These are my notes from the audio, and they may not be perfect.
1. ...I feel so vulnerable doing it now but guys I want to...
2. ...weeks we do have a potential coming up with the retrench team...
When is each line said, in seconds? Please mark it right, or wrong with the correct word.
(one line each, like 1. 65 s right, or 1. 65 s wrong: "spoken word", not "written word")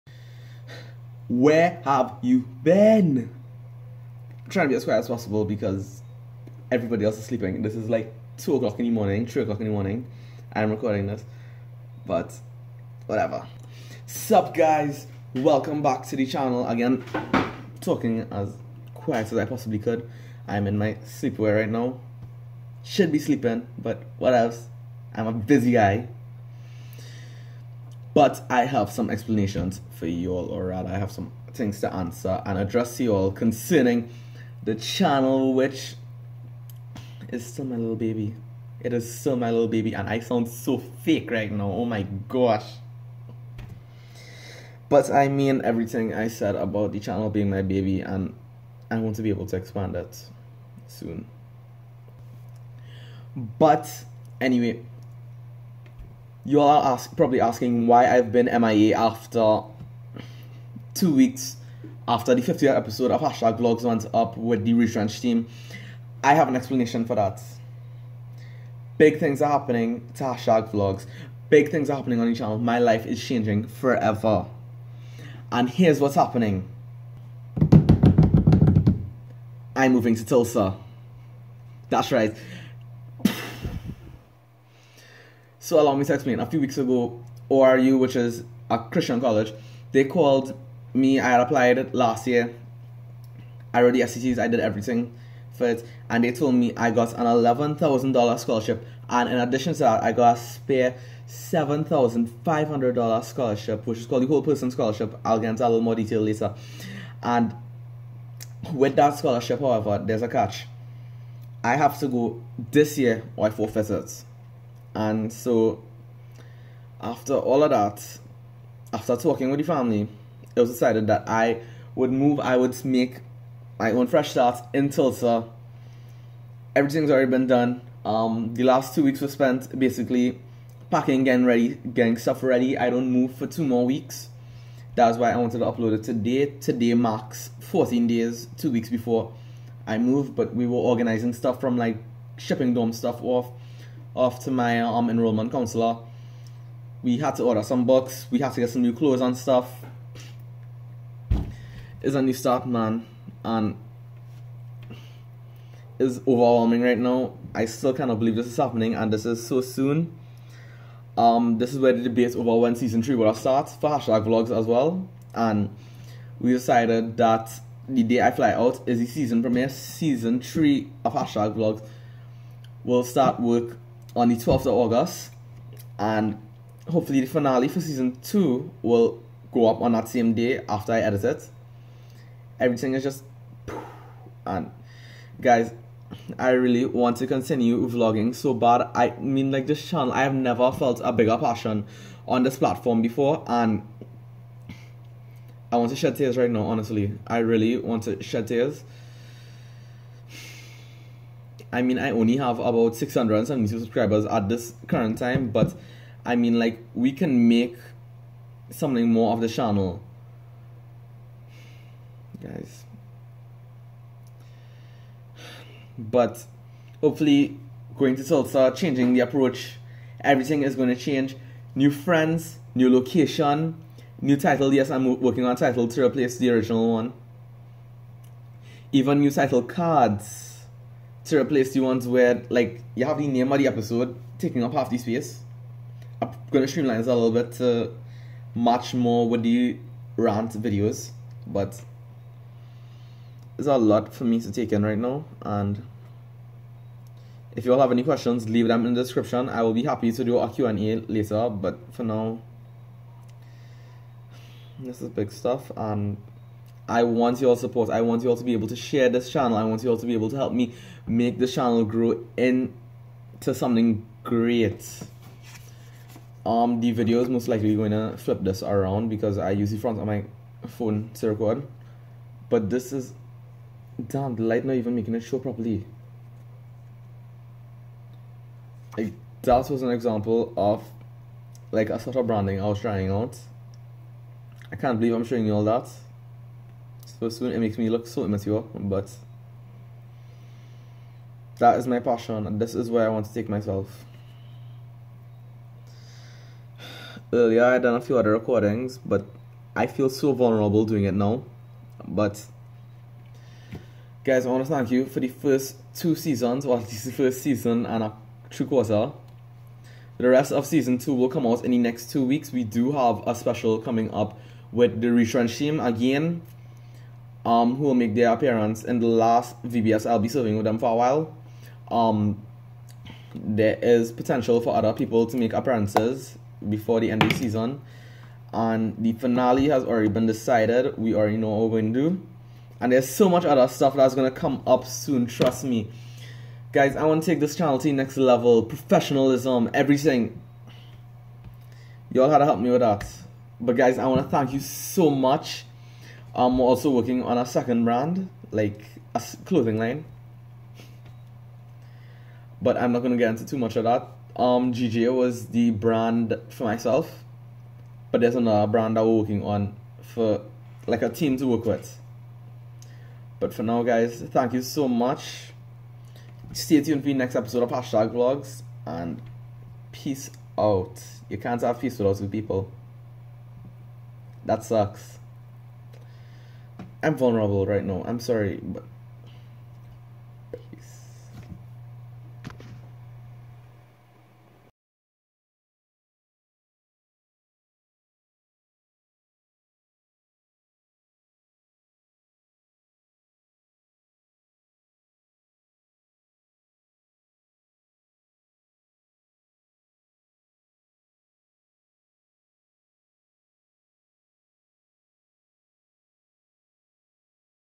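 1. 299 s right
2. 312 s wrong: "special", not "potential".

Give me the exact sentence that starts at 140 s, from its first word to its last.
but we were organizing stuff from like shipping dorm stuff off after my um, enrollment counselor.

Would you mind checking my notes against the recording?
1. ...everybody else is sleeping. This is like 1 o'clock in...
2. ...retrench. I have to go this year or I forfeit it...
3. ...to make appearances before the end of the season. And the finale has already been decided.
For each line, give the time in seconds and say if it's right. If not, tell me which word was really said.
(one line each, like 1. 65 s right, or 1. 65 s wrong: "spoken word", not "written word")
1. 6 s wrong: "2", not "1"
2. 110 s wrong: "catch", not "retrench"
3. 325 s right.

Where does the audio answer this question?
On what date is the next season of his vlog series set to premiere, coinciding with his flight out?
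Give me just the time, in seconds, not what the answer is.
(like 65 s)
174 s.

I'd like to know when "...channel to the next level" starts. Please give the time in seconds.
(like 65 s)
337 s.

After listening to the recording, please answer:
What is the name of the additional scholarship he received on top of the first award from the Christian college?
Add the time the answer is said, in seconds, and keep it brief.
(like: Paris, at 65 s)
whole person scholarship, at 104 s.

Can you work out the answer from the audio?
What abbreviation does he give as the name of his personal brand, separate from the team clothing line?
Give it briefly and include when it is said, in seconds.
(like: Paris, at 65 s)
GGA, at 354 s.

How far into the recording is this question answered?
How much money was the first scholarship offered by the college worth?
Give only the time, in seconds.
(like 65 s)
97 s.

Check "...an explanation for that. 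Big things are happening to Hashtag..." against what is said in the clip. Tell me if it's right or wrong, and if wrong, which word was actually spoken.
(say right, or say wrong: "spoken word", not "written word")
right.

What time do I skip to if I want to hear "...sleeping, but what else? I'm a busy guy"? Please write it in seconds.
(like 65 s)
23 s.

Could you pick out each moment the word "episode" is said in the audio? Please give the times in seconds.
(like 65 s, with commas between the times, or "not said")
62 s, 233 s, 367 s.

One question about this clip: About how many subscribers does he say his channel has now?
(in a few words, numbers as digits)
672.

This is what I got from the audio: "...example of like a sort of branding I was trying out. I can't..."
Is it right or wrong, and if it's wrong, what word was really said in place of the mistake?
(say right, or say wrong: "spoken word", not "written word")
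right.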